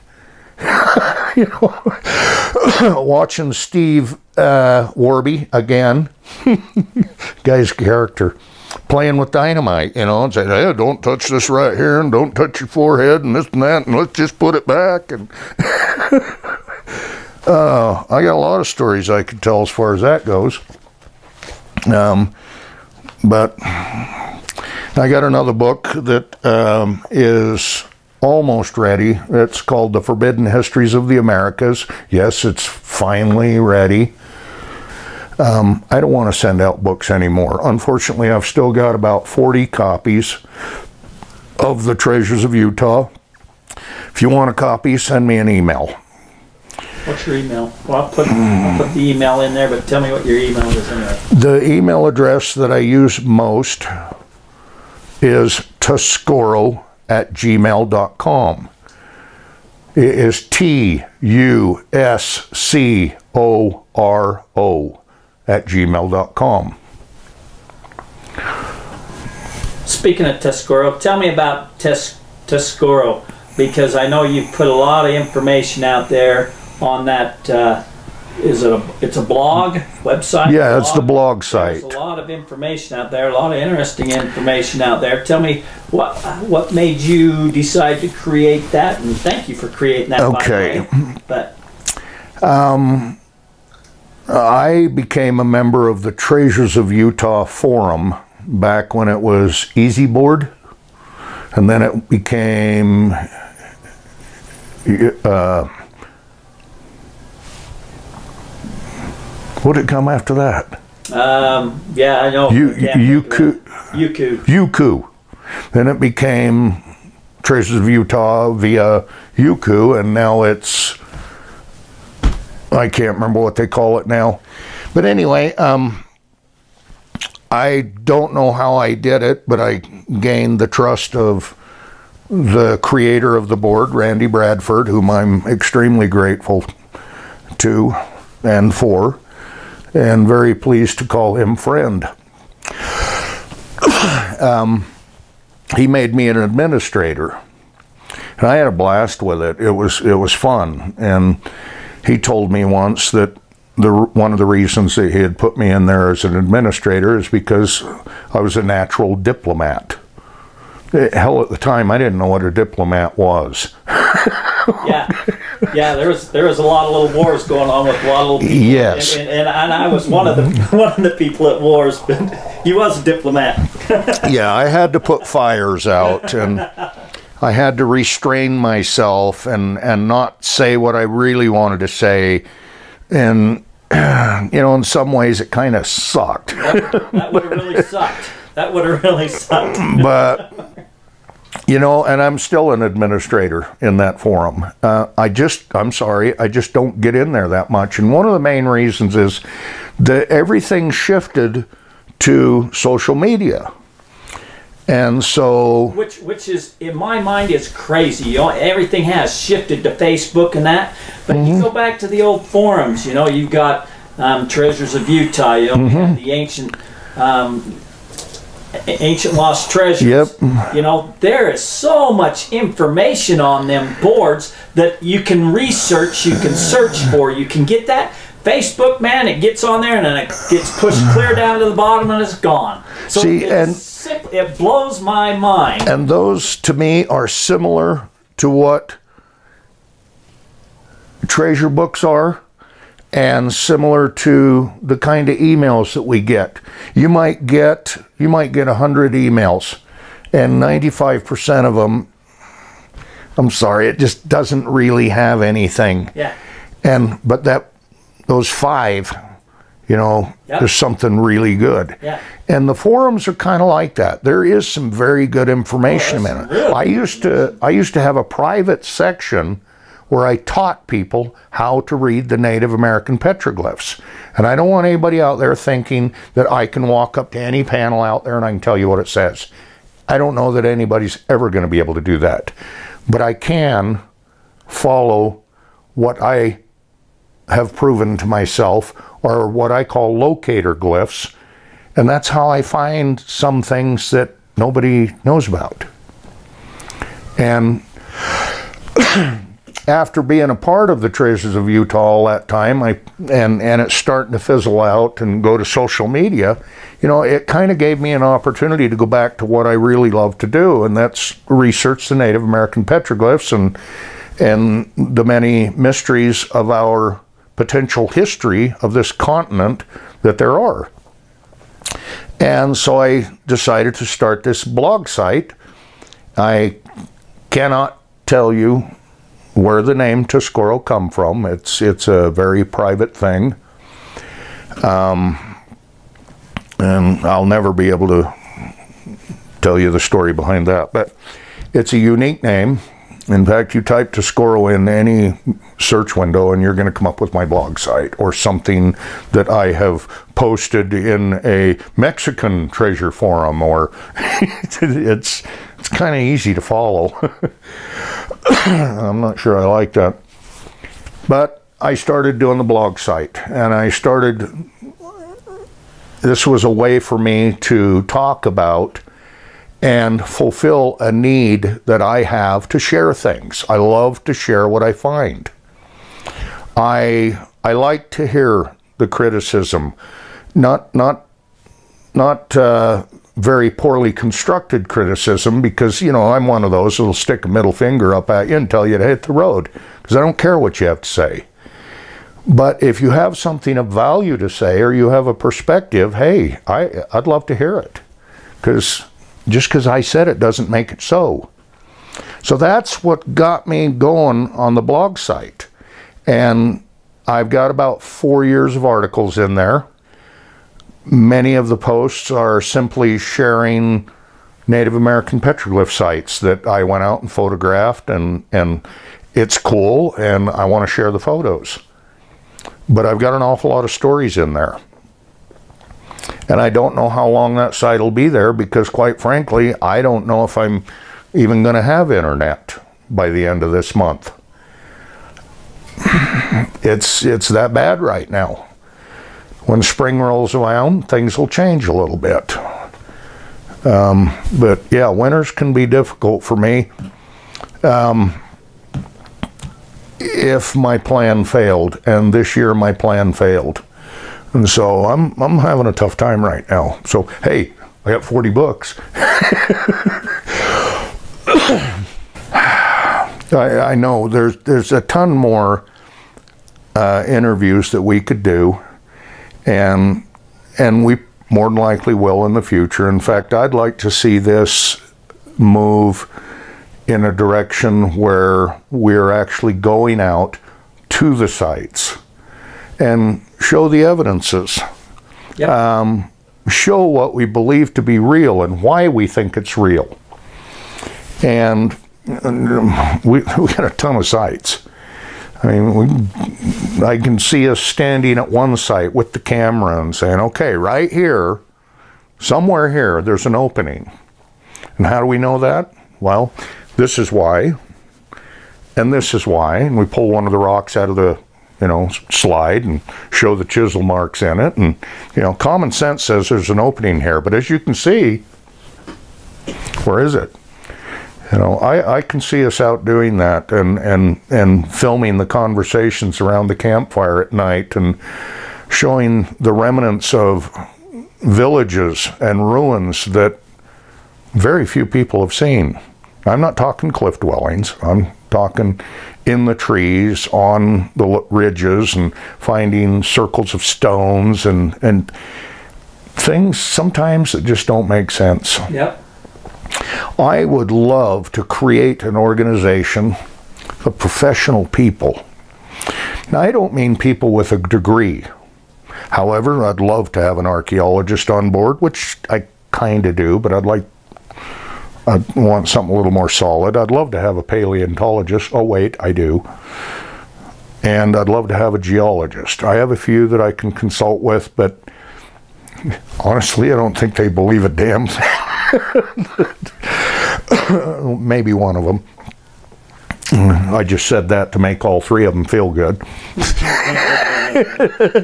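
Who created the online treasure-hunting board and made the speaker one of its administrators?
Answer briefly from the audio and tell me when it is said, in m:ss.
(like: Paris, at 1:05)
Randy Bradford, at 2:13.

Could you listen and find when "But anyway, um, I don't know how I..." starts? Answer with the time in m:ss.
2:04.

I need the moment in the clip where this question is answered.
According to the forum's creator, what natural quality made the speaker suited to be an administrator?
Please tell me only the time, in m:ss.
2:38.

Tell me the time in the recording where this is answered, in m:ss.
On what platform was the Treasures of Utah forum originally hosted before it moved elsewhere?
1:39.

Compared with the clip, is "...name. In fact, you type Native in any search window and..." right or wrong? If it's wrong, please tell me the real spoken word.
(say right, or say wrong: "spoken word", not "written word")
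wrong: "Tuscoro", not "Native".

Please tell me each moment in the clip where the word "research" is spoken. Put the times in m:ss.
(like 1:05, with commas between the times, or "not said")
3:45, 5:11.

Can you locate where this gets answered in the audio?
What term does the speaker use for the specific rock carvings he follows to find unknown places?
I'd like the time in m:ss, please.
4:50.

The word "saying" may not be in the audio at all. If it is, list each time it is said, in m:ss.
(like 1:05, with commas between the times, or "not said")
0:10, 8:20.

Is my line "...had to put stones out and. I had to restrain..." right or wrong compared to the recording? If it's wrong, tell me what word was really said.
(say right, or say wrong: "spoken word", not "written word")
wrong: "fires", not "stones".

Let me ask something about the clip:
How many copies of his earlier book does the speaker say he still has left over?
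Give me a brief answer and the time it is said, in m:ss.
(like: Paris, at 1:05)
40, at 0:38.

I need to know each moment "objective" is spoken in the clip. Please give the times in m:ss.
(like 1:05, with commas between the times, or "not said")
not said.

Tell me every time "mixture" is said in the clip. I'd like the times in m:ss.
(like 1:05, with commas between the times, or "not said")
not said.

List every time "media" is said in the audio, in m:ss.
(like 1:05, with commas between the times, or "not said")
3:23, 5:06.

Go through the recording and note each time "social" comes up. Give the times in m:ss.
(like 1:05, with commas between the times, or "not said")
3:22, 5:05.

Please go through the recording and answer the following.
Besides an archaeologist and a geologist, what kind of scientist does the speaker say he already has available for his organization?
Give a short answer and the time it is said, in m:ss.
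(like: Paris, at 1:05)
paleontologist, at 9:27.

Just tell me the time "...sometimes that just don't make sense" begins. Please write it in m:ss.
9:06.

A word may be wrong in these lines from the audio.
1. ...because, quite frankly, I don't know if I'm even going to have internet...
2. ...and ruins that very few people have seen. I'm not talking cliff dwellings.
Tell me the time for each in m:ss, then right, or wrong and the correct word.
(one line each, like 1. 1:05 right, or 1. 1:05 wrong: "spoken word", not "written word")
1. 7:08 right
2. 8:52 right.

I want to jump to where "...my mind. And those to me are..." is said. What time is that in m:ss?
3:54.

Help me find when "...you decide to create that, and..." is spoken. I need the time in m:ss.
1:26.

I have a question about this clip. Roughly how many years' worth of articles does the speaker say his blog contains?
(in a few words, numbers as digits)
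4 years.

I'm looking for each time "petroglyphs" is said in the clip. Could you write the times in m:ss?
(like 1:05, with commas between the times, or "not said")
4:33, 5:12, 6:55.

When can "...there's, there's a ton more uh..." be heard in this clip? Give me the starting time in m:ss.
7:44.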